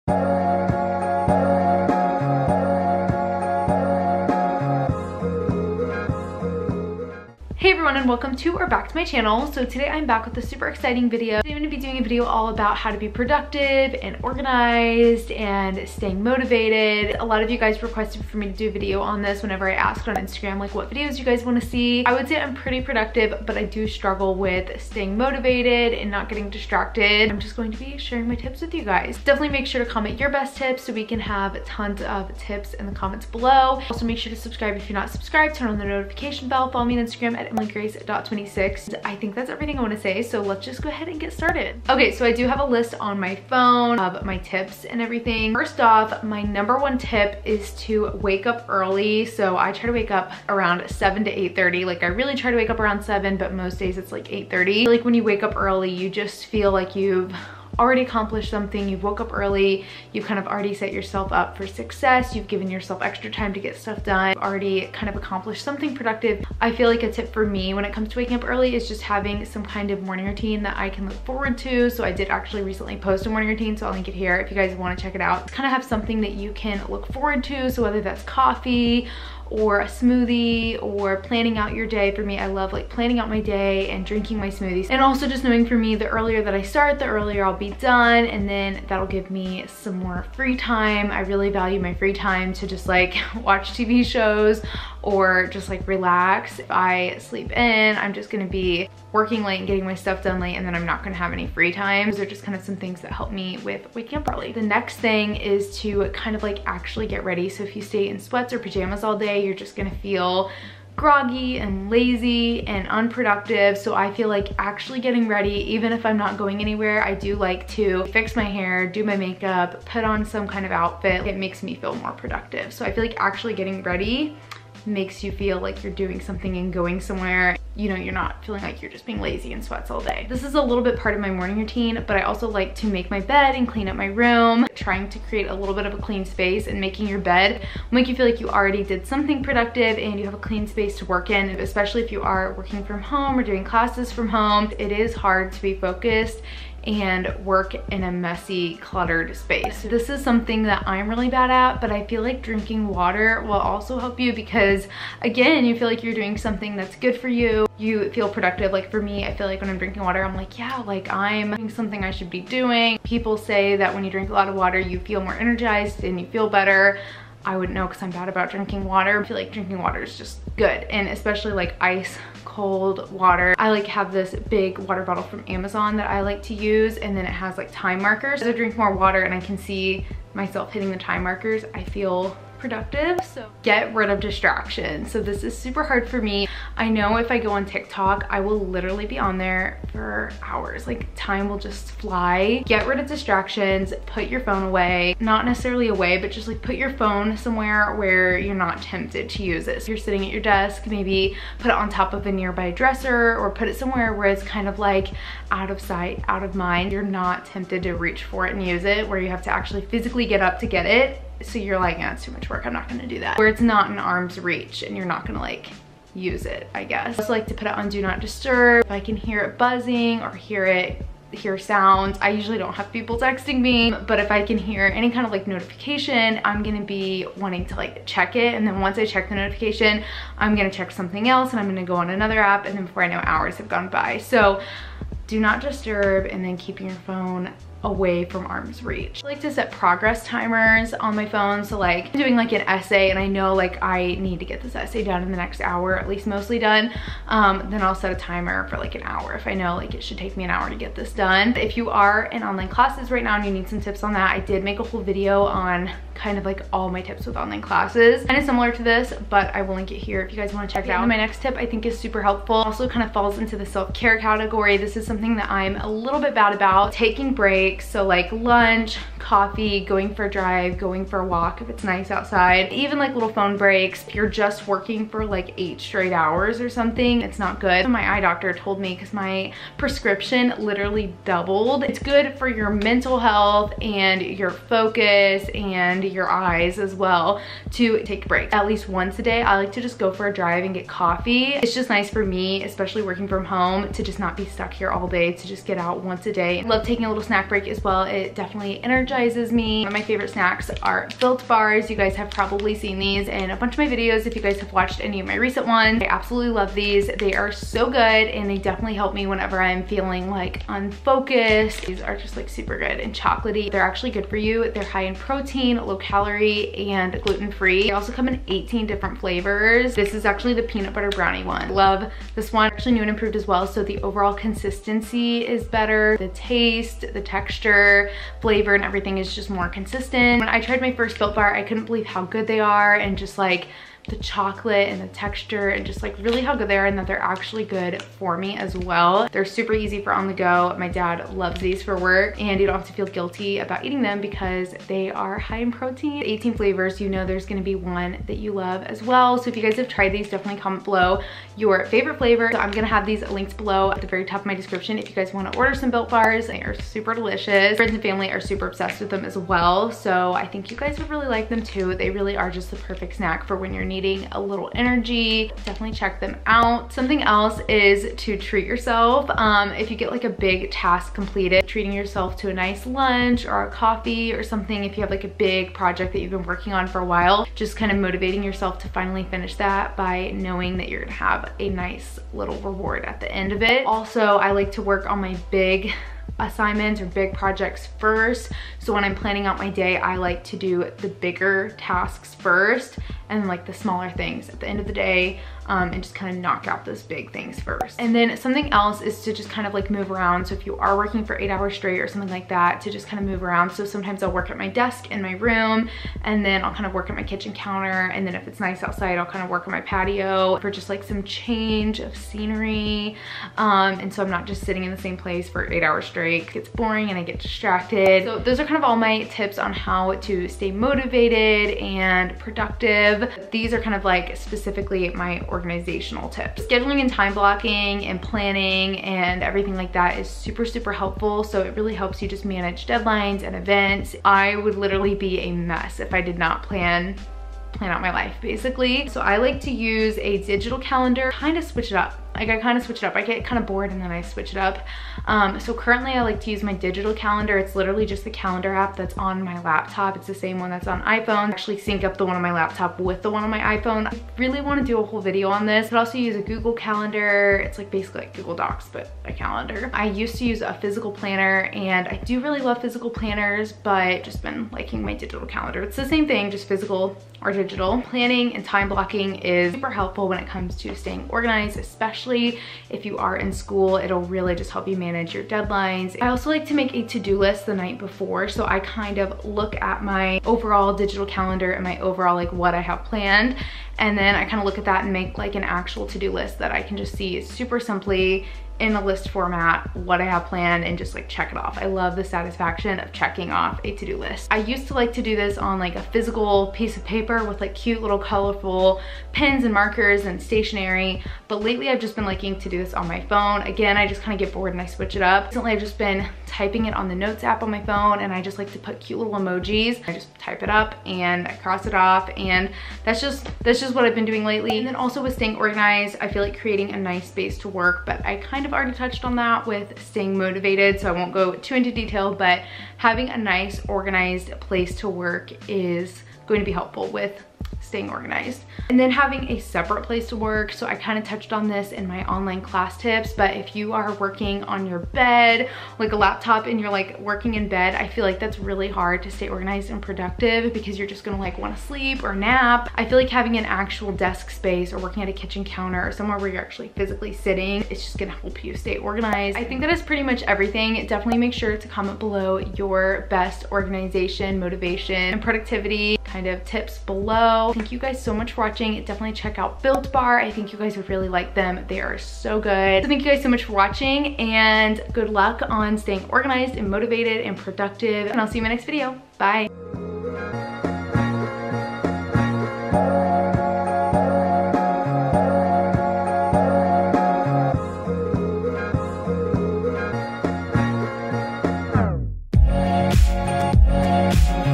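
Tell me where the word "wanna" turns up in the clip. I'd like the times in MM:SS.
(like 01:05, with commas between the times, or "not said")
00:21, 00:39, 01:14, 05:55, 09:01.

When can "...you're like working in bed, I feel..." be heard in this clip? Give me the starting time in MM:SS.
08:56.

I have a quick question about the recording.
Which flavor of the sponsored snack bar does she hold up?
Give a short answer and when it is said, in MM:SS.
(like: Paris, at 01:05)
Peanut butter brownie, at 05:20.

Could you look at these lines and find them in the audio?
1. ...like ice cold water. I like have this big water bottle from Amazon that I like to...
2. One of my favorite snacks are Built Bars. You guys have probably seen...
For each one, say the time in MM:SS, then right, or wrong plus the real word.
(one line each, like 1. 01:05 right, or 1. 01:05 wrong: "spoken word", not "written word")
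1. 02:51 right
2. 04:59 right.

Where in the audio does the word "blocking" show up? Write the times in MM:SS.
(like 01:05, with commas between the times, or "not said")
07:07, 07:48.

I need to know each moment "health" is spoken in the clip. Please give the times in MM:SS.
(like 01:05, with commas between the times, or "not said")
04:43.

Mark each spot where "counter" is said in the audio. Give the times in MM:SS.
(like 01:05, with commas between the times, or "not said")
06:47, 09:05.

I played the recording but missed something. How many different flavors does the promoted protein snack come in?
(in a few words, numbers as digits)
18.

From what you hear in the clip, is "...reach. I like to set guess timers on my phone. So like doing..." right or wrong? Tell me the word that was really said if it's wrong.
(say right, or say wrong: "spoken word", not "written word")
wrong: "progress", not "guess".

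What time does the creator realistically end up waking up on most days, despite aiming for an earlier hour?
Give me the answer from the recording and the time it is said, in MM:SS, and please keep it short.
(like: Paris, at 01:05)
8:30, at 00:53.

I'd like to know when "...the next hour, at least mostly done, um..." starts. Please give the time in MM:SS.
04:05.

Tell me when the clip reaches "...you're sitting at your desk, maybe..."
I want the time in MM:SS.
03:19.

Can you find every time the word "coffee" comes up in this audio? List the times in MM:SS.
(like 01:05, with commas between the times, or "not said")
01:18, 04:29, 04:50, 06:13.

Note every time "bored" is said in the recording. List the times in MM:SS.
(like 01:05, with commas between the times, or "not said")
07:23, 08:24.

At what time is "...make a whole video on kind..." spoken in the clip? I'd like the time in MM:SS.
04:14.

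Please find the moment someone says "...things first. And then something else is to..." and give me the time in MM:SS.
06:37.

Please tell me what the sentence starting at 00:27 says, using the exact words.
I'm just going to be sharing my tips with you guys.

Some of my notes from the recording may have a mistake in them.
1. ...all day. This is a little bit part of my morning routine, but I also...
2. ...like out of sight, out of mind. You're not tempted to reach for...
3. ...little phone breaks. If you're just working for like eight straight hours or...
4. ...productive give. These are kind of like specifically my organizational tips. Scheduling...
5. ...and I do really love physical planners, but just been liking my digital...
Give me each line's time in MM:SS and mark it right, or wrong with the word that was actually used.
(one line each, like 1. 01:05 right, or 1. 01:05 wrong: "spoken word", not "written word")
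1. 02:09 right
2. 03:24 right
3. 04:33 right
4. 07:02 right
5. 07:41 right.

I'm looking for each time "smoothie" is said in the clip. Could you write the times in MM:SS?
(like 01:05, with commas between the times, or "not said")
01:19, 01:24.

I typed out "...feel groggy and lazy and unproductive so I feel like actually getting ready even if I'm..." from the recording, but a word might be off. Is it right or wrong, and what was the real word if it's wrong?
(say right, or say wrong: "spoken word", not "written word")
right.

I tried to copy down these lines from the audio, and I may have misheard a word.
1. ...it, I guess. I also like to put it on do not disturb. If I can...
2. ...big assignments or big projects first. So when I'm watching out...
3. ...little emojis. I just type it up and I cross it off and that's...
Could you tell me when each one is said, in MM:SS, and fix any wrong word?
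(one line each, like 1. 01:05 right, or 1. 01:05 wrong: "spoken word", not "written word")
1. 03:36 right
2. 06:25 wrong: "planning", not "watching"
3. 08:29 right.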